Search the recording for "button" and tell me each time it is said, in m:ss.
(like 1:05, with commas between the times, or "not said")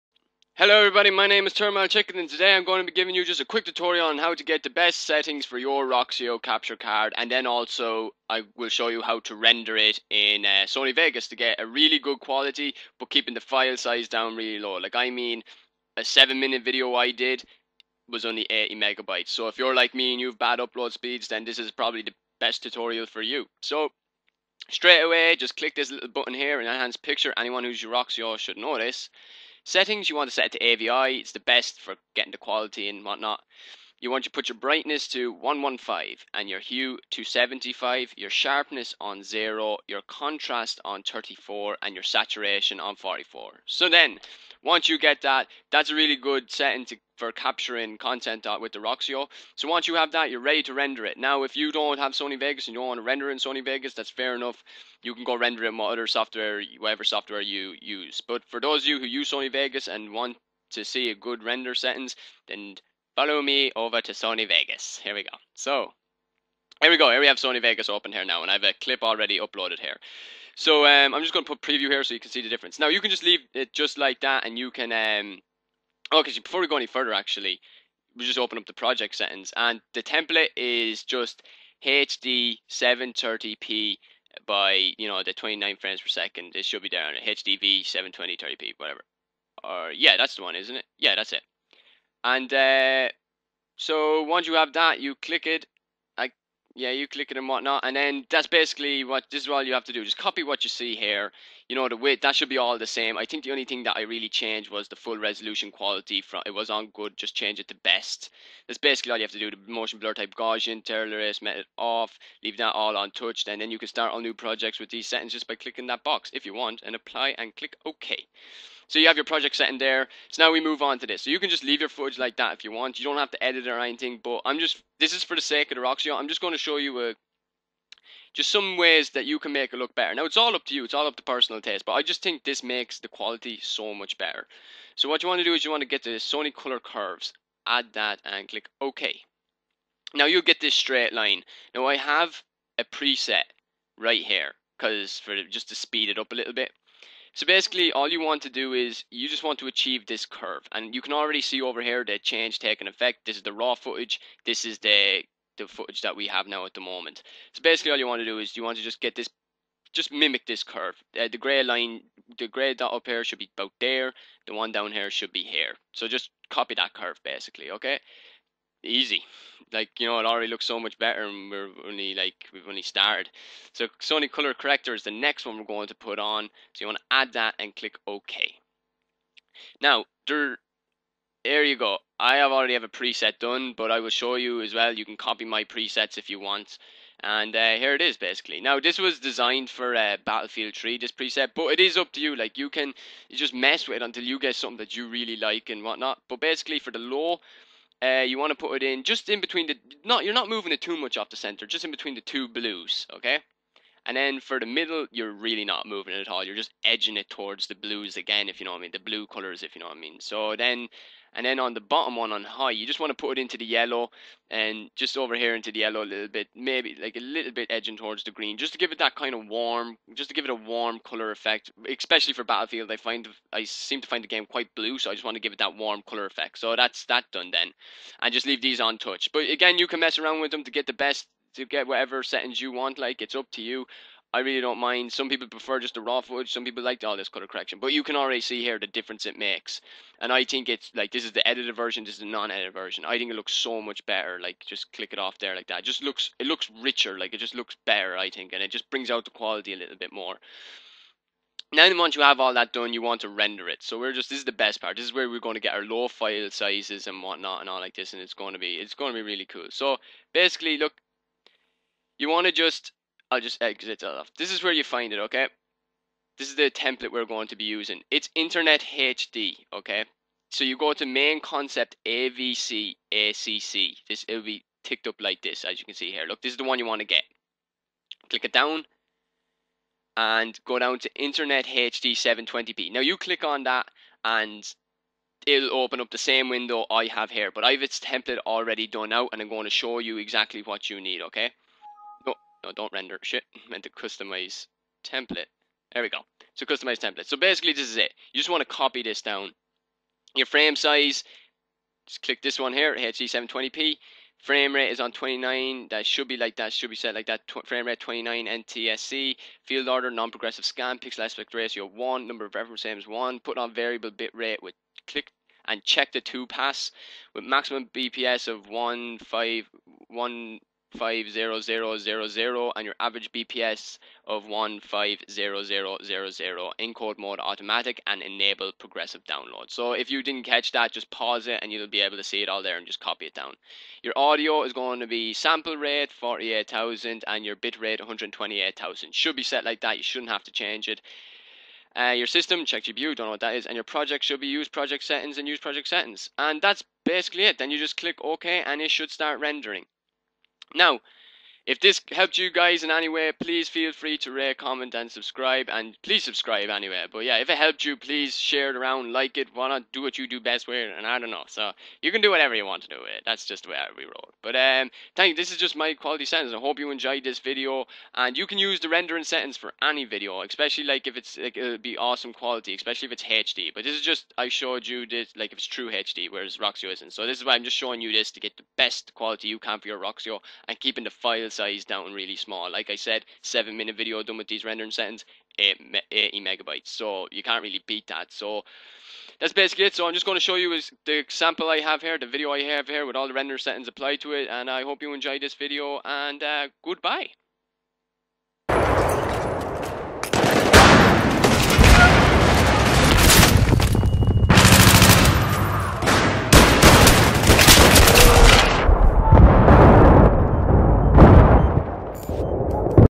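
0:26.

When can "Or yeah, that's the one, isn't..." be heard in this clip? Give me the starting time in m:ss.
1:29.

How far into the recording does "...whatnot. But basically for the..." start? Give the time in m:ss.
3:15.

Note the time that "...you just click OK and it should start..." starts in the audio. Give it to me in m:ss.
5:47.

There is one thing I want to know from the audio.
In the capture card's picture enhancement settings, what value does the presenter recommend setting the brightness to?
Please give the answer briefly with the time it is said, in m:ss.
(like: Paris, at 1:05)
115, at 0:35.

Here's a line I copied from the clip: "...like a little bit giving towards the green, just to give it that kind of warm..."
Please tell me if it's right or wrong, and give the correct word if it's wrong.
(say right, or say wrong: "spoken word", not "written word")
wrong: "edging", not "giving".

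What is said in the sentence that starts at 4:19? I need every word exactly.
So basically, look, you want to just, I'll just exit off.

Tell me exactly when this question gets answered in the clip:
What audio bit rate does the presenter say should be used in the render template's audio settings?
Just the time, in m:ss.
5:38.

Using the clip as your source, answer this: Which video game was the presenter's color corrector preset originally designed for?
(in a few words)
Battlefield 3.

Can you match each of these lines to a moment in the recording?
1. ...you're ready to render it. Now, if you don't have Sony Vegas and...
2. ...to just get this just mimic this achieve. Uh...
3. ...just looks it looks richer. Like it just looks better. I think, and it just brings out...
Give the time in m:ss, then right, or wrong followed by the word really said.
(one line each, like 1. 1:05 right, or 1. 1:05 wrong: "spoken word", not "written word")
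1. 0:50 right
2. 2:38 wrong: "curve", not "achieve"
3. 4:05 right.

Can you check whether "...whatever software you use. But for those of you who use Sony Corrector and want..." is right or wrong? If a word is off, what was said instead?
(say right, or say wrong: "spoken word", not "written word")
wrong: "Vegas", not "Corrector".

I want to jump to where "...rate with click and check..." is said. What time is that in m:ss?
5:14.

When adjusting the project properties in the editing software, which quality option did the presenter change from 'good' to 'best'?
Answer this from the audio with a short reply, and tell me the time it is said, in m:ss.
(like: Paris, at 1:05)
Full resolution quality, at 1:44.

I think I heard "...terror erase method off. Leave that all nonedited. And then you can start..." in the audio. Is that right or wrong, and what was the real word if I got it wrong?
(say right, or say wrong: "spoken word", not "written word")
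wrong: "untouched", not "nonedited".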